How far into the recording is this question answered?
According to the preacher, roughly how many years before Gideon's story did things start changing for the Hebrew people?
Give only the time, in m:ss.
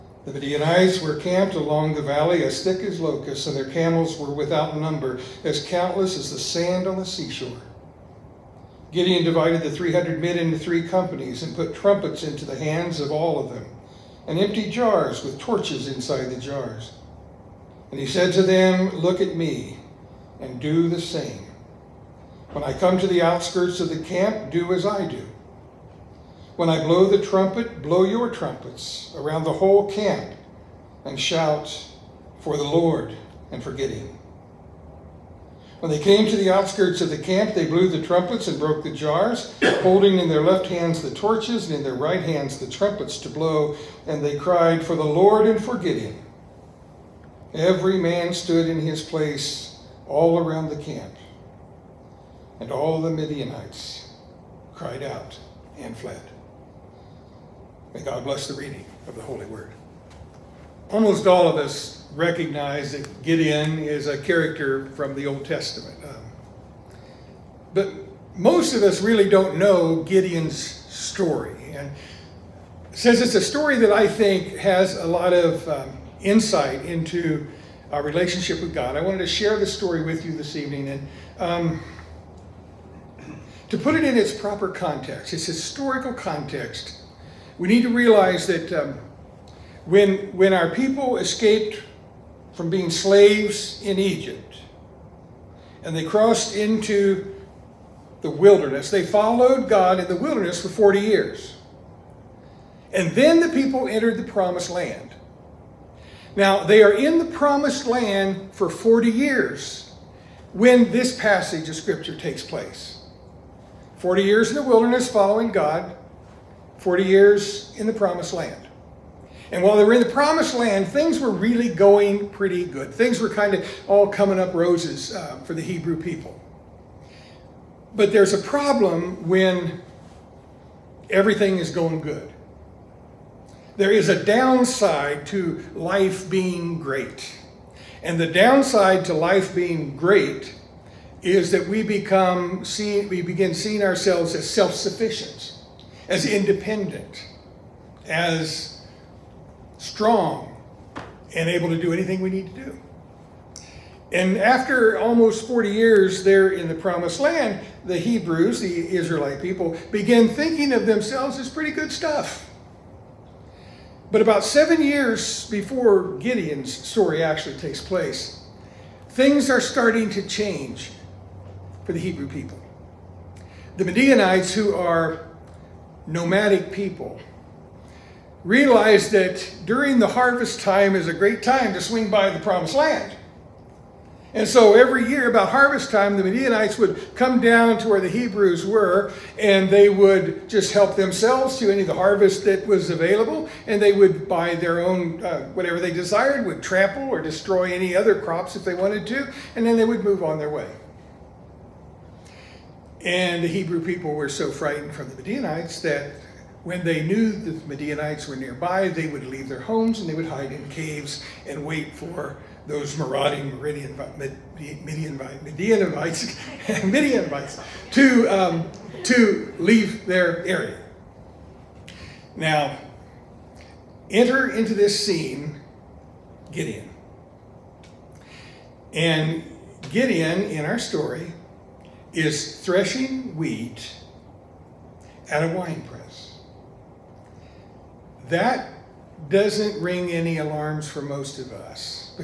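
2:44.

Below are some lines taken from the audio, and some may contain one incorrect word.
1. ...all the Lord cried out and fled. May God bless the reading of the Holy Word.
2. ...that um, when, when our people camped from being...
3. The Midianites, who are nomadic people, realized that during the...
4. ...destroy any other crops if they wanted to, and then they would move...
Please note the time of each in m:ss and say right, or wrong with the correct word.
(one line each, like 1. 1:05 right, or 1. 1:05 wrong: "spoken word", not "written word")
1. 0:52 wrong: "Midianites", not "Lord"
2. 1:28 wrong: "escaped", not "camped"
3. 2:53 right
4. 3:17 right.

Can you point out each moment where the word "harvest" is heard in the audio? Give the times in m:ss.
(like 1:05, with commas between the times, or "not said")
3:00, 3:05, 3:11.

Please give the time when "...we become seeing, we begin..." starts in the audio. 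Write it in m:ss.
2:21.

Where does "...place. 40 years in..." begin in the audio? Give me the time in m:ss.
1:52.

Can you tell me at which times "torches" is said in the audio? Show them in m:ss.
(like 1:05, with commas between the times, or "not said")
0:15, 0:41.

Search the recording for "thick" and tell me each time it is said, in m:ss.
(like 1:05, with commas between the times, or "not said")
0:02.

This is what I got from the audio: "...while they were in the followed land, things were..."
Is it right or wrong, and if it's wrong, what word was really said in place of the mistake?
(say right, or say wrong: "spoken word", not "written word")
wrong: "promised", not "followed".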